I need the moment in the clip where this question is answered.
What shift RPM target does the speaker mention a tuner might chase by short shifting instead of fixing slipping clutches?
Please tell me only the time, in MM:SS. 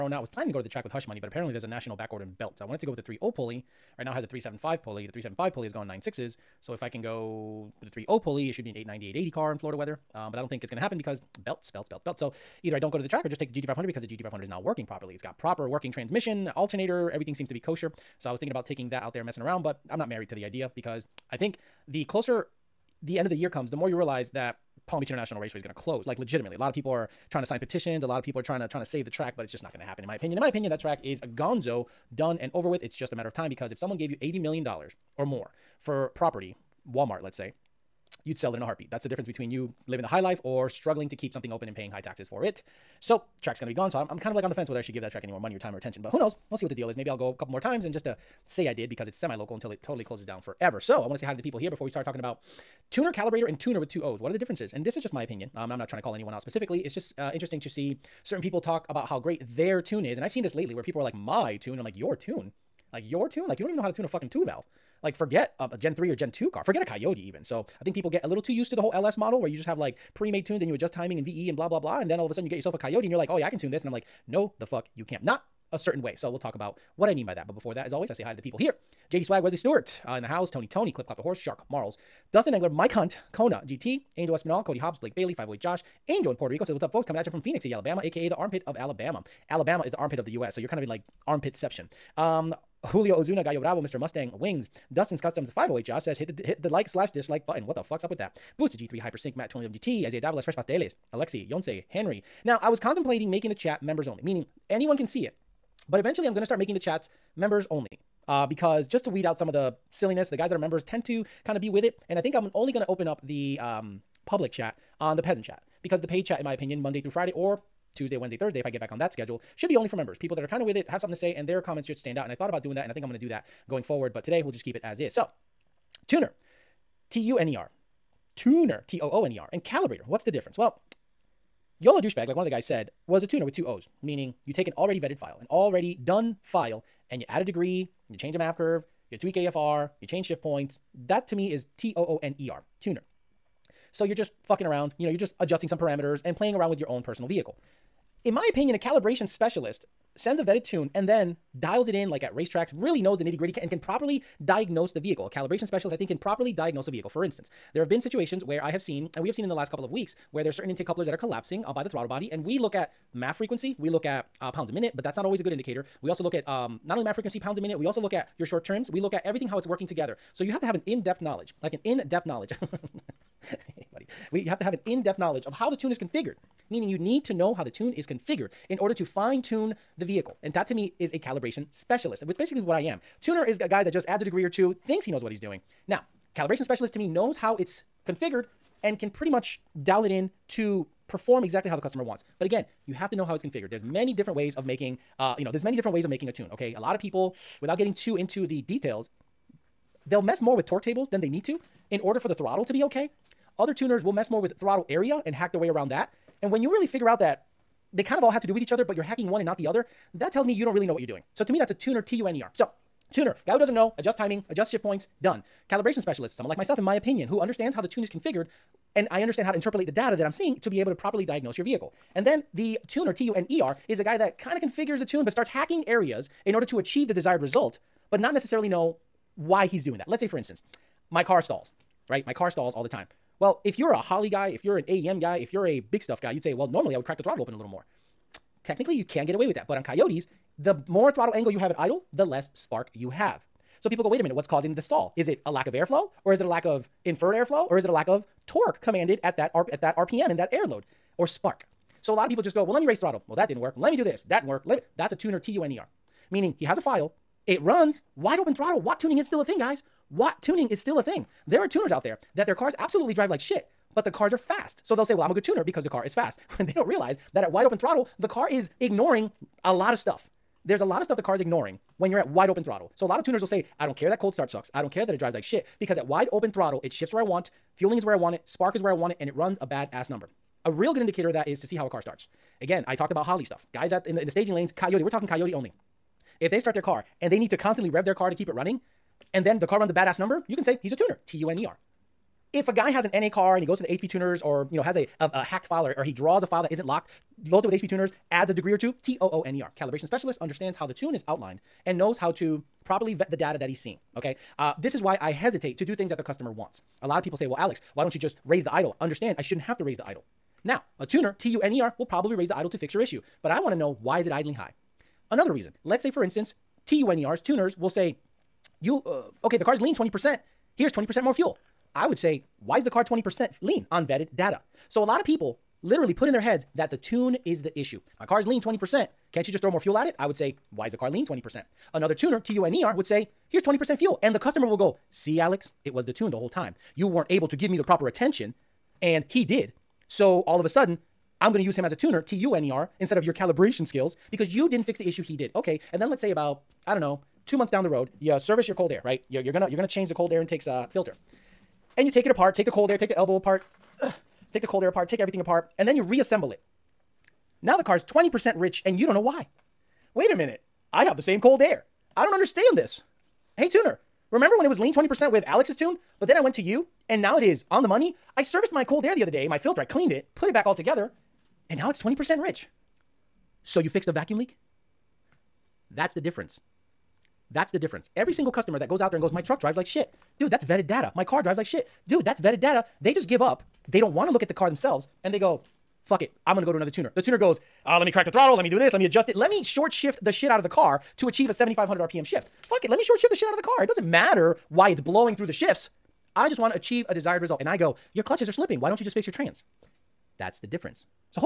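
06:31.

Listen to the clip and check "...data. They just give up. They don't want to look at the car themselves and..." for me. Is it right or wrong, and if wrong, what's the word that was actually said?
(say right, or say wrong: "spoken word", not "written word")
right.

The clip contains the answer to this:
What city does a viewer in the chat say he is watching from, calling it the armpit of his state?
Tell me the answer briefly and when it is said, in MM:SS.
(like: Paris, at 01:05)
Phenix City, at 01:27.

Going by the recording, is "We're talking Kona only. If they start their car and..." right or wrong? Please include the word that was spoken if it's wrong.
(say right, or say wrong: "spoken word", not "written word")
wrong: "Coyote", not "Kona".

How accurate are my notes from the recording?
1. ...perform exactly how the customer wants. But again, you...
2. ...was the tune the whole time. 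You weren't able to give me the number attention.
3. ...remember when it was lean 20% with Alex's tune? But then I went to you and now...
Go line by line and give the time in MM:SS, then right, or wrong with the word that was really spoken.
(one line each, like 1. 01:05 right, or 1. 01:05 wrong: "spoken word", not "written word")
1. 03:11 right
2. 05:35 wrong: "proper", not "number"
3. 06:04 right.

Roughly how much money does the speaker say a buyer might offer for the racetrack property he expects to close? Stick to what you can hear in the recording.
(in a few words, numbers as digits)
80 million dollars.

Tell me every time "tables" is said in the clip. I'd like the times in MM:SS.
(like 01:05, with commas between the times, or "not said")
03:20.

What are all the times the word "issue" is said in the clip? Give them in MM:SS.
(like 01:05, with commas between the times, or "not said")
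05:12, 05:27, 05:45.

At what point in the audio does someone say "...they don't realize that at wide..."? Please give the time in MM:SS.
04:26.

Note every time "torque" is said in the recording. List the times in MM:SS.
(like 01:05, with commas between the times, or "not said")
03:20, 04:08.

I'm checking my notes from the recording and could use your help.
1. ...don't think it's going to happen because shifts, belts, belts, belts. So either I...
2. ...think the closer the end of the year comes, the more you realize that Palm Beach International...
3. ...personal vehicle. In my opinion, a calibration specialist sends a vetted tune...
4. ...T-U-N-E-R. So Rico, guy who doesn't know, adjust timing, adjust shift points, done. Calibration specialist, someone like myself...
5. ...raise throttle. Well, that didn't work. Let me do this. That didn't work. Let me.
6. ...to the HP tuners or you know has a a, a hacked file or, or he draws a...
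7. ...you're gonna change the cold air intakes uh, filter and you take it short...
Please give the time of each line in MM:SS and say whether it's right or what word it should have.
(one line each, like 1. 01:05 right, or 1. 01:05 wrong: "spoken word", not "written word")
1. 00:10 wrong: "belts", not "shifts"
2. 00:21 right
3. 02:27 right
4. 03:32 wrong: "Tuner", not "Rico"
5. 04:12 right
6. 04:53 right
7. 05:49 wrong: "apart", not "short".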